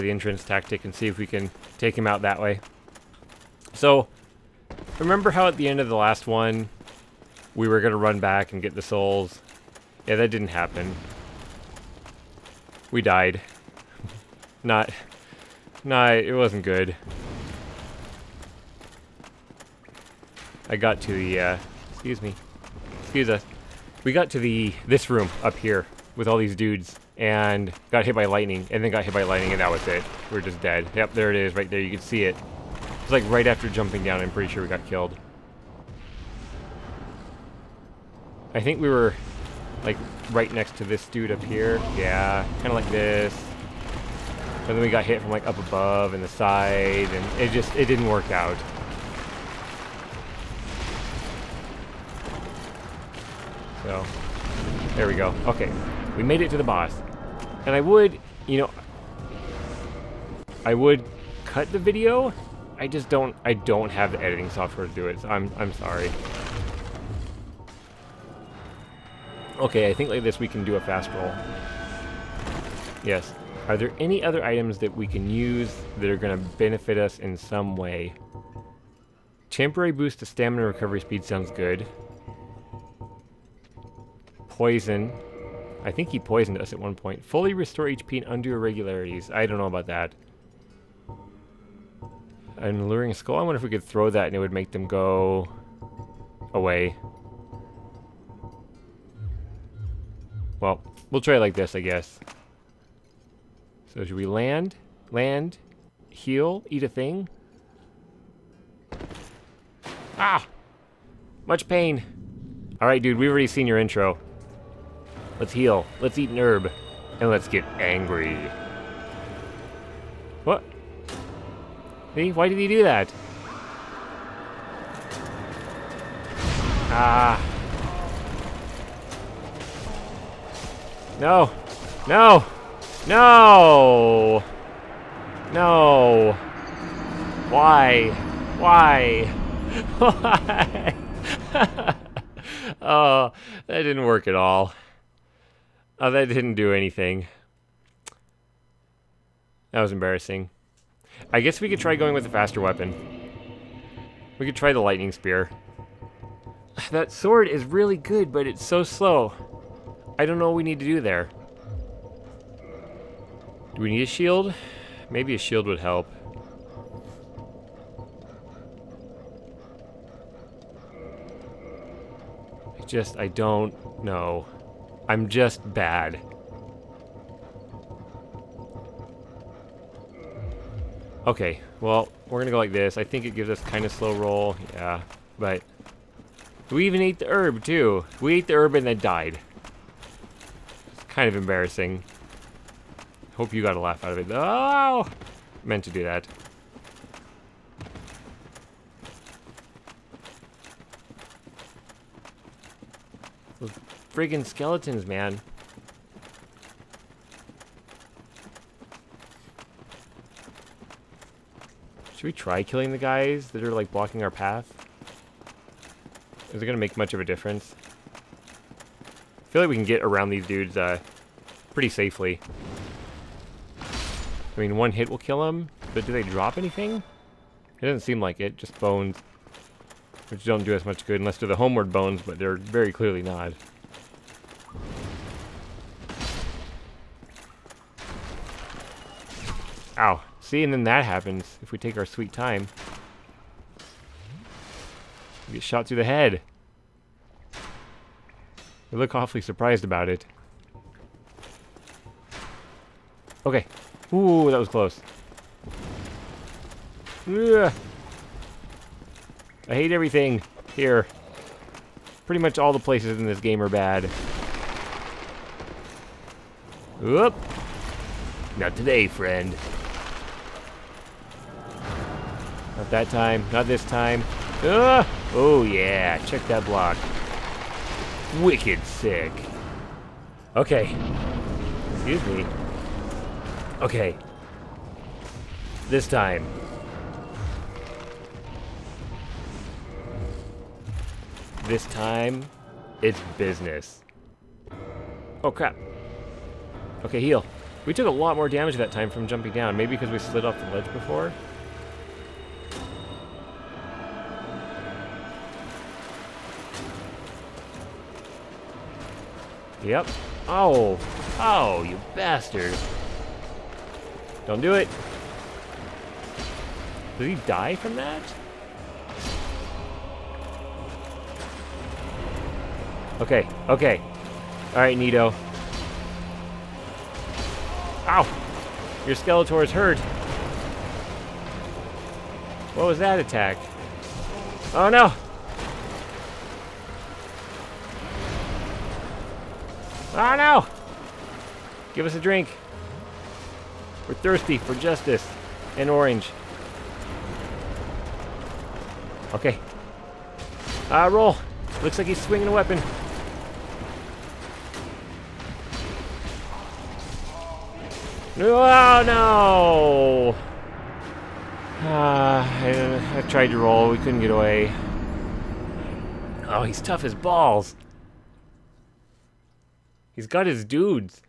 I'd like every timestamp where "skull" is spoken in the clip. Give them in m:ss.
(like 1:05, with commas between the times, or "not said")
1:33.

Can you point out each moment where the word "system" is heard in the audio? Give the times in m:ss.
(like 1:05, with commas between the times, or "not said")
not said.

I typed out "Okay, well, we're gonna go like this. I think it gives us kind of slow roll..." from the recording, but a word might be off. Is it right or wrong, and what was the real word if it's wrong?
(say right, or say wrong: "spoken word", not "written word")
right.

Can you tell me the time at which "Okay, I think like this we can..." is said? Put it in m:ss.
1:09.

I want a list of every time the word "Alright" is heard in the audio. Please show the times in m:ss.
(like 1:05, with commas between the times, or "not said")
5:24.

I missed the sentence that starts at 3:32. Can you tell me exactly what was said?
Should we try killing the guys that are, like, blocking our path?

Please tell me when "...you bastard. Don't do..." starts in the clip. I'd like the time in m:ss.
5:11.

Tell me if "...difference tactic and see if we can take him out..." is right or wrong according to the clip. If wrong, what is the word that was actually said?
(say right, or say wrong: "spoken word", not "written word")
wrong: "entrance", not "difference".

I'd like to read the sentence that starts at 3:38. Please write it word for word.
I feel like we can get around these dudes, uh, pretty safely.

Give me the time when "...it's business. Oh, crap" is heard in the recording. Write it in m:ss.
4:53.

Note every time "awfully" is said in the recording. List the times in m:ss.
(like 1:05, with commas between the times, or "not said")
4:09.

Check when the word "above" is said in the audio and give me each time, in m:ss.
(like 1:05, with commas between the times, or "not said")
0:45.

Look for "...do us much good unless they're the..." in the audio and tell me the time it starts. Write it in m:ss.
3:50.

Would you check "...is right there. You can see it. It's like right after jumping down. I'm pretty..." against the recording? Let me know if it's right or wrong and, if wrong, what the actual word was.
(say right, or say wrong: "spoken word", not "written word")
right.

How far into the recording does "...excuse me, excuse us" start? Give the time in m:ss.
0:21.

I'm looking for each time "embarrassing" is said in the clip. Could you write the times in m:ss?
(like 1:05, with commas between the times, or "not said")
2:29, 3:11.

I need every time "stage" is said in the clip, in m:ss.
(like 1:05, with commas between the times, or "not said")
not said.